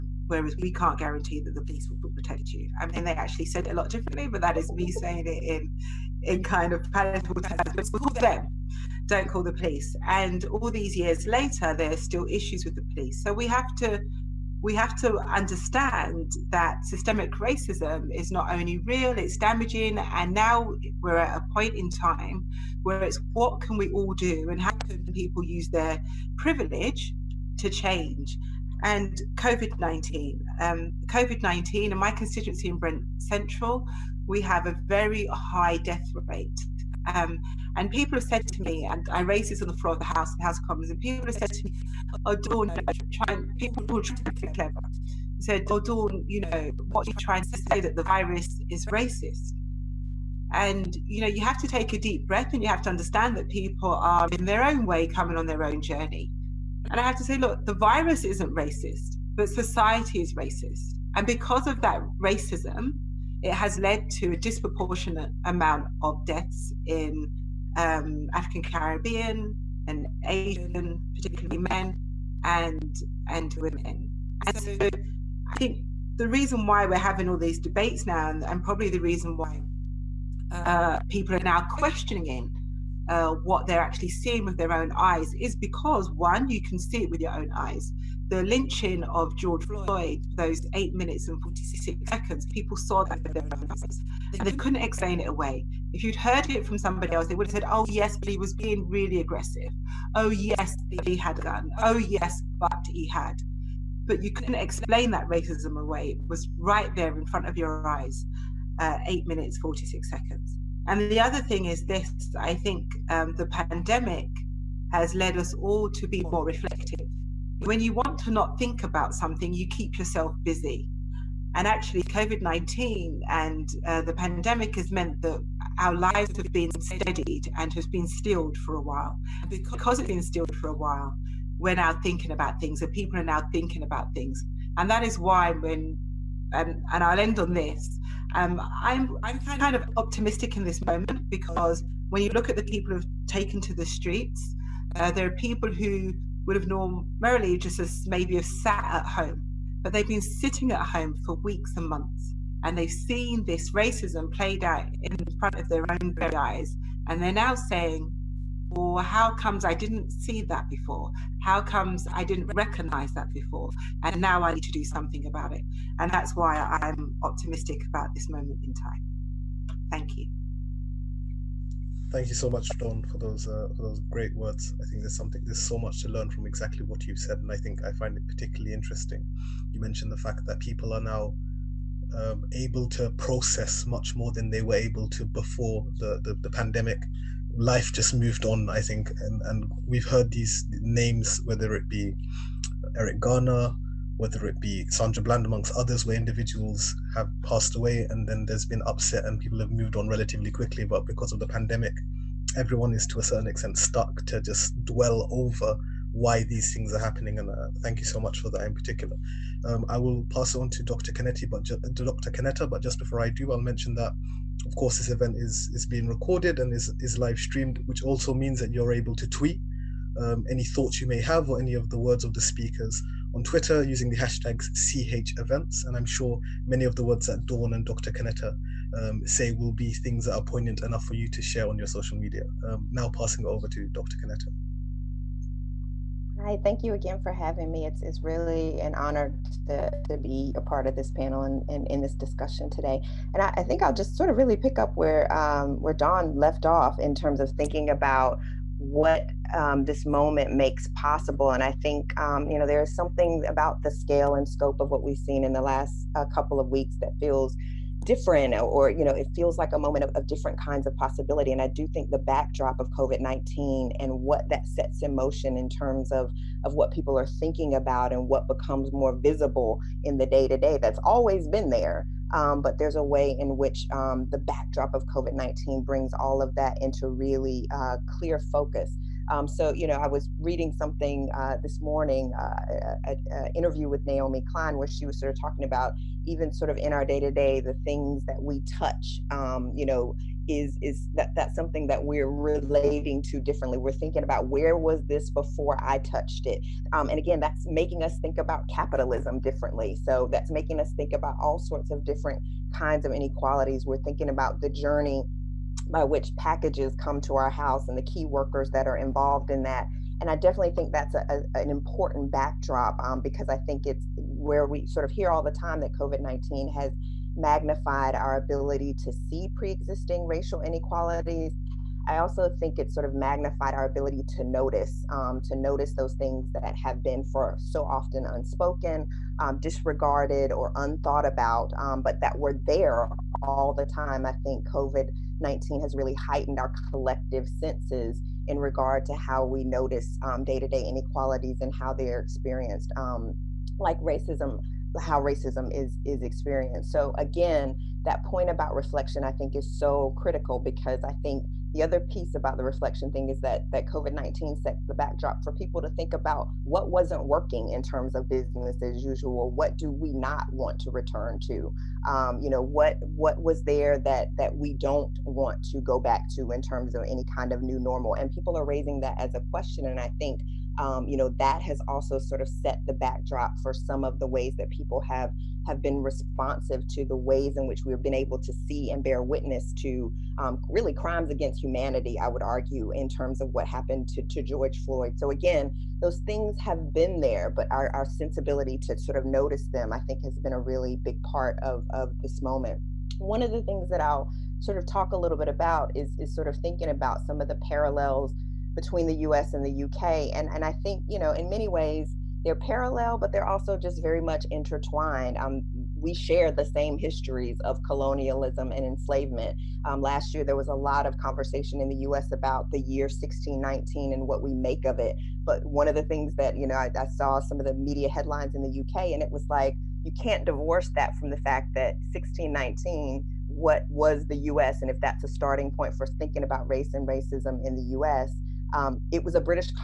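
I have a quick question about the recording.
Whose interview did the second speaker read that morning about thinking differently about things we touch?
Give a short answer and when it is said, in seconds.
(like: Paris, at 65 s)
Naomi Klein, at 284 s.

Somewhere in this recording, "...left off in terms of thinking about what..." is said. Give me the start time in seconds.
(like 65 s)
246 s.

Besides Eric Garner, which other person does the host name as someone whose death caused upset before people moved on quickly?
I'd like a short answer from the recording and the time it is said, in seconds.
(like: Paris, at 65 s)
Sandra Bland, at 194 s.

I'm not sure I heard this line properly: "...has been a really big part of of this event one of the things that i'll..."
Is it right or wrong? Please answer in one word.
wrong.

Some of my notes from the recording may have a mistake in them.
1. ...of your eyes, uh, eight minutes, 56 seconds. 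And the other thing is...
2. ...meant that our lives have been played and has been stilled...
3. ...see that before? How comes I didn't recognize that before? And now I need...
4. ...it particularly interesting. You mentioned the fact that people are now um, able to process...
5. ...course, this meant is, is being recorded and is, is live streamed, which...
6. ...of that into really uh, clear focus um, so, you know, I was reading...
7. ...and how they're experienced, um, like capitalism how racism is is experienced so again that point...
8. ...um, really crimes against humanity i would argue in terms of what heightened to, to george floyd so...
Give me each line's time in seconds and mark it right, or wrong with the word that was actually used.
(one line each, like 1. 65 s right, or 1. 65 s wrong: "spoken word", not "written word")
1. 107 s wrong: "46", not "56"
2. 124 s wrong: "steadied", not "played"
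3. 160 s right
4. 178 s right
5. 214 s wrong: "event", not "meant"
6. 276 s right
7. 341 s wrong: "racism", not "capitalism"
8. 380 s wrong: "happened", not "heightened".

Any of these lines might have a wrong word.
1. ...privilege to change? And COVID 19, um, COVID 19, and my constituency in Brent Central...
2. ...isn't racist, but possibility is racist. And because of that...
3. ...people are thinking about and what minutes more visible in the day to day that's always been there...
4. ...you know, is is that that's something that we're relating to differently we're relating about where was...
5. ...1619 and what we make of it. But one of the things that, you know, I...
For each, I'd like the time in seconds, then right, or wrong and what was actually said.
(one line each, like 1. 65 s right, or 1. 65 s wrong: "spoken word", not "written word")
1. 26 s right
2. 58 s wrong: "society", not "possibility"
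3. 266 s wrong: "becomes", not "minutes"
4. 289 s wrong: "thinking", not "relating"
5. 413 s right.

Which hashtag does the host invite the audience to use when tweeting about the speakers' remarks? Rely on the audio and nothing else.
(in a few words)
CH events.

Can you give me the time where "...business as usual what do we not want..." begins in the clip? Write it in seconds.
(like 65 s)
358 s.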